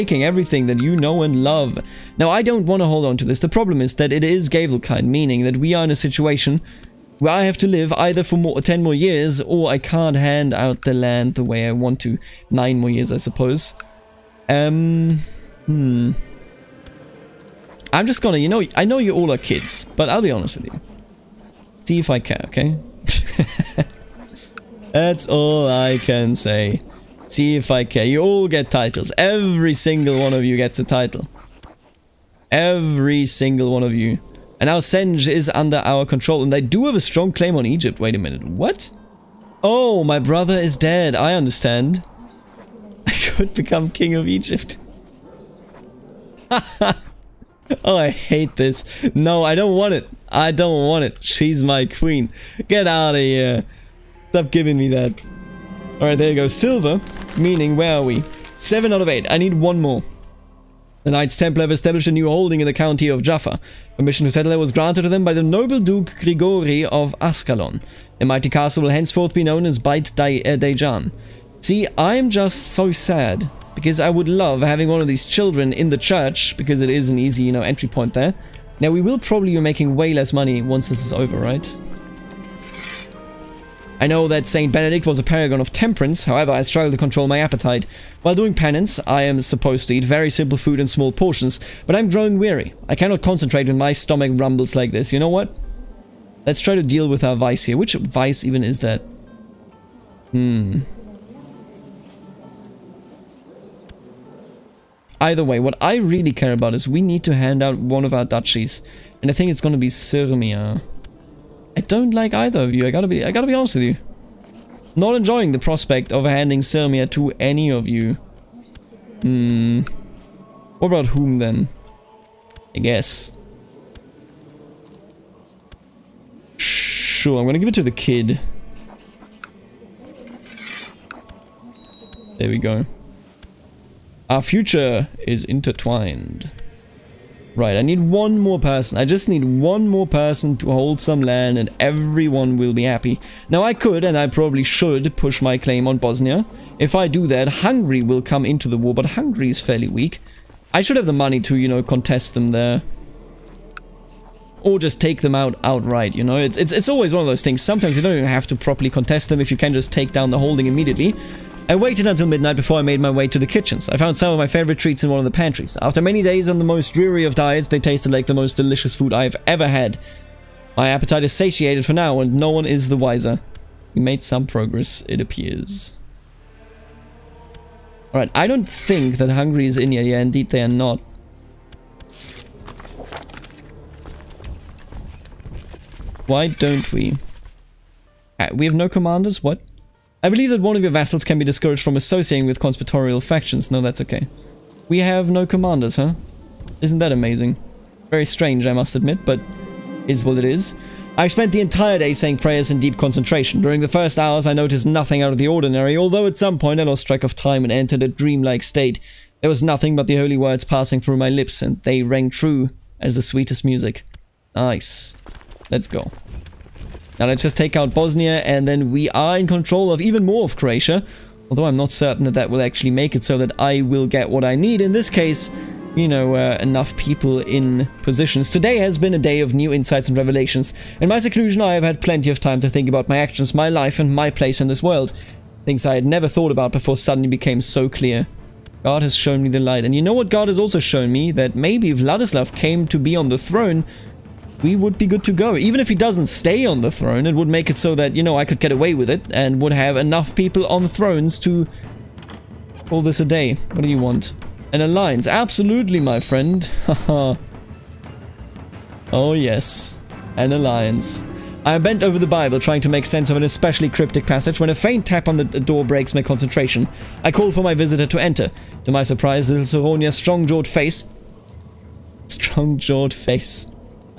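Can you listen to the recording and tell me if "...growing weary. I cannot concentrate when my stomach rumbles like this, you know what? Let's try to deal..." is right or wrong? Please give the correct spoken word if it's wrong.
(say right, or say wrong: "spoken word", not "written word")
right.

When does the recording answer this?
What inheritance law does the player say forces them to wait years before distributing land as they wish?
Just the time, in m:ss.
0:04.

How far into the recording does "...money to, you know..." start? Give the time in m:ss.
2:31.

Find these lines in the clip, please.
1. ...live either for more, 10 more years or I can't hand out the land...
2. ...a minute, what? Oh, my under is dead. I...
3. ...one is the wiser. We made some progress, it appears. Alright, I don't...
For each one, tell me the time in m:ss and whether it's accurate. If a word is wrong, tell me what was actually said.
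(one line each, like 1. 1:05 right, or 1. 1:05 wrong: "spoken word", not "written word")
1. 0:07 right
2. 0:38 wrong: "brother", not "under"
3. 2:52 right.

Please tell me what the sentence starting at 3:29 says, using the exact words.
There was nothing but the holy words passing through my lips, and they rang true as the sweetest music.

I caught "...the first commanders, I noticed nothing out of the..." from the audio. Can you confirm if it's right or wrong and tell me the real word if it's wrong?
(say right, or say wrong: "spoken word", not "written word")
wrong: "hours", not "commanders".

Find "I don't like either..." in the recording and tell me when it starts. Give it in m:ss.
1:51.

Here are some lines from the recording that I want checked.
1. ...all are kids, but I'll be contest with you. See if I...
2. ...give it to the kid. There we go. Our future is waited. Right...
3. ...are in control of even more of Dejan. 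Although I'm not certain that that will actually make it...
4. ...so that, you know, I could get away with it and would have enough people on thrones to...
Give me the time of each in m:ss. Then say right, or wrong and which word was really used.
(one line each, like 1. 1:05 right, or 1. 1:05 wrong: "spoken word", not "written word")
1. 0:19 wrong: "honest", not "contest"
2. 2:07 wrong: "intertwined", not "waited"
3. 3:39 wrong: "Croatia", not "Dejan"
4. 4:07 right.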